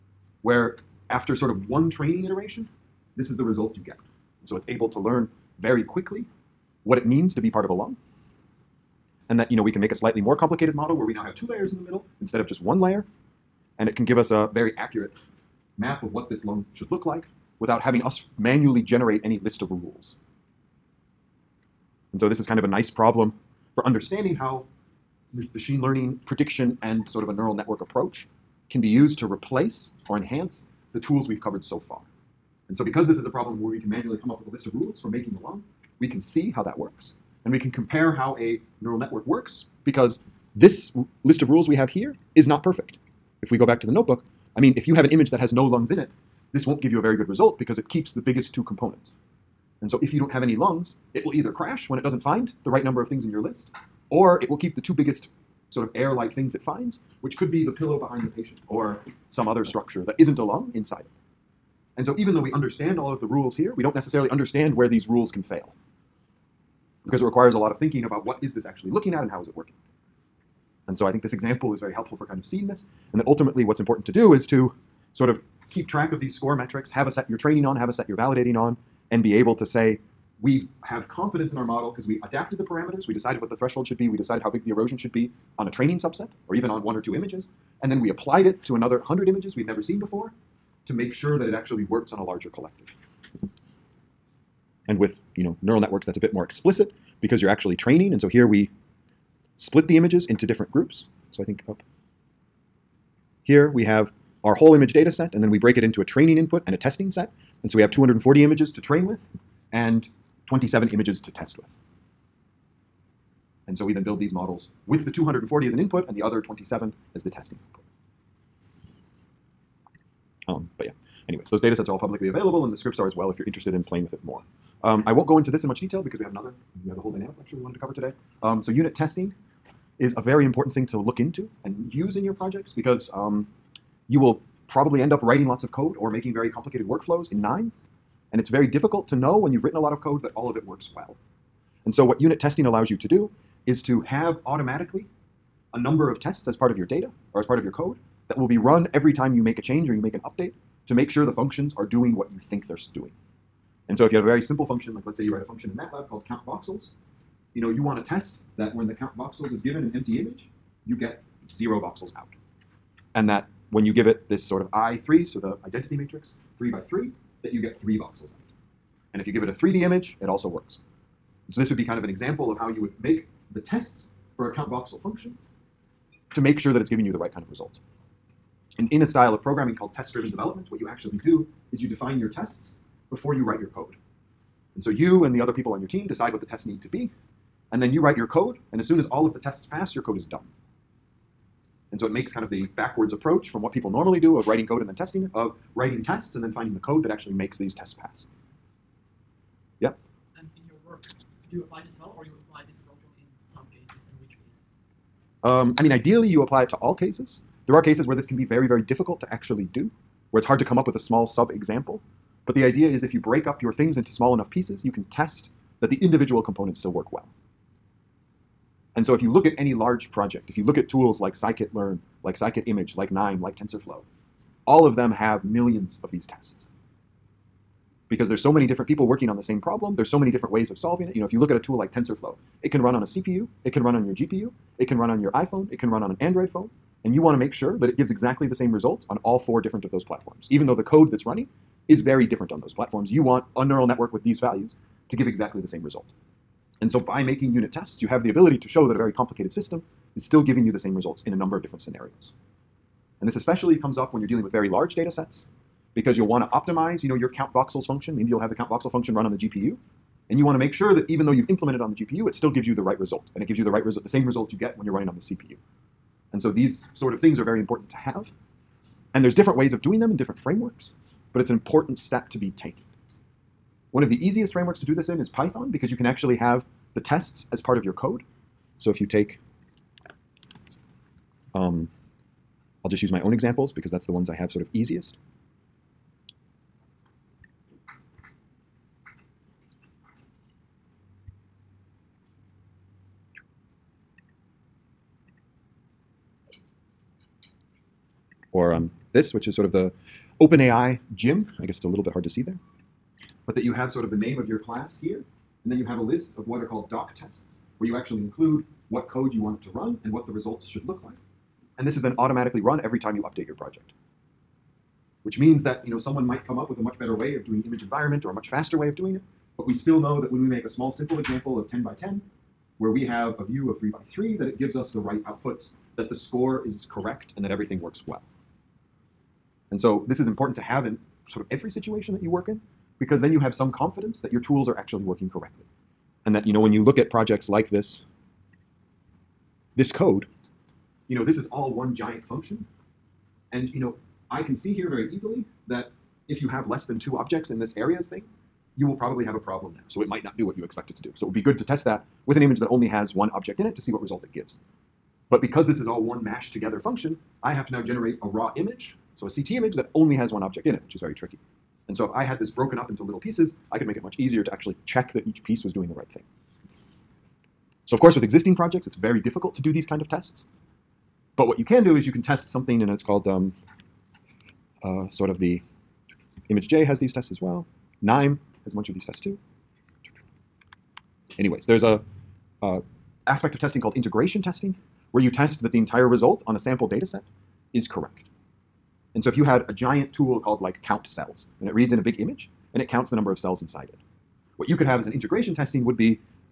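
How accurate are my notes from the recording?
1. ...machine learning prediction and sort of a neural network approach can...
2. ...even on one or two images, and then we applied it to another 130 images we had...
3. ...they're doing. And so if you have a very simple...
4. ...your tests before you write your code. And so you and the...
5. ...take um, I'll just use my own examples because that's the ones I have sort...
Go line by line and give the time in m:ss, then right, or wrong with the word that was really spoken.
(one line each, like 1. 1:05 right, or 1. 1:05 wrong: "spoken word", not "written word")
1. 0:25 right
2. 1:26 wrong: "100", not "130"
3. 2:32 right
4. 3:02 right
5. 4:39 right.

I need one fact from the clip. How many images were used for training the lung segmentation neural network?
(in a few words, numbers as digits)
240.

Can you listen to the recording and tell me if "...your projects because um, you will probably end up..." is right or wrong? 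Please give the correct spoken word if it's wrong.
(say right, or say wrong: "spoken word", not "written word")
right.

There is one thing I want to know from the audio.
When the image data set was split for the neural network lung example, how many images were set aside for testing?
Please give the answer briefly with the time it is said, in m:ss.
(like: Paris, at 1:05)
27, at 1:50.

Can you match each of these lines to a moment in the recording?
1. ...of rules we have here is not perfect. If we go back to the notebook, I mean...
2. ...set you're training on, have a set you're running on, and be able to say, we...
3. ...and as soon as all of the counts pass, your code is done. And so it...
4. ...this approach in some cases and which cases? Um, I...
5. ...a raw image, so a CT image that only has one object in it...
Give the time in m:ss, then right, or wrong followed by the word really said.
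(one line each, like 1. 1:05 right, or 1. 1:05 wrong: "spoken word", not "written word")
1. 0:41 right
2. 1:17 wrong: "validating", not "running"
3. 3:08 wrong: "tests", not "counts"
4. 3:22 right
5. 5:58 right.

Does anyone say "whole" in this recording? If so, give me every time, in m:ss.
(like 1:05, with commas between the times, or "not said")
1:44, 2:07.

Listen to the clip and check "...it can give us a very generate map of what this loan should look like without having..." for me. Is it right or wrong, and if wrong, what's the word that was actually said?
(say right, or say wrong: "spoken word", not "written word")
wrong: "accurate", not "generate".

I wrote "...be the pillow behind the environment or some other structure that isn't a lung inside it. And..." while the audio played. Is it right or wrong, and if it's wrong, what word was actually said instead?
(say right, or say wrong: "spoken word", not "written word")
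wrong: "patient", not "environment".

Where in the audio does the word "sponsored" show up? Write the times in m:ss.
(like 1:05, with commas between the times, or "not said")
not said.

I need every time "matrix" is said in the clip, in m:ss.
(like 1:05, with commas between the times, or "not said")
2:45.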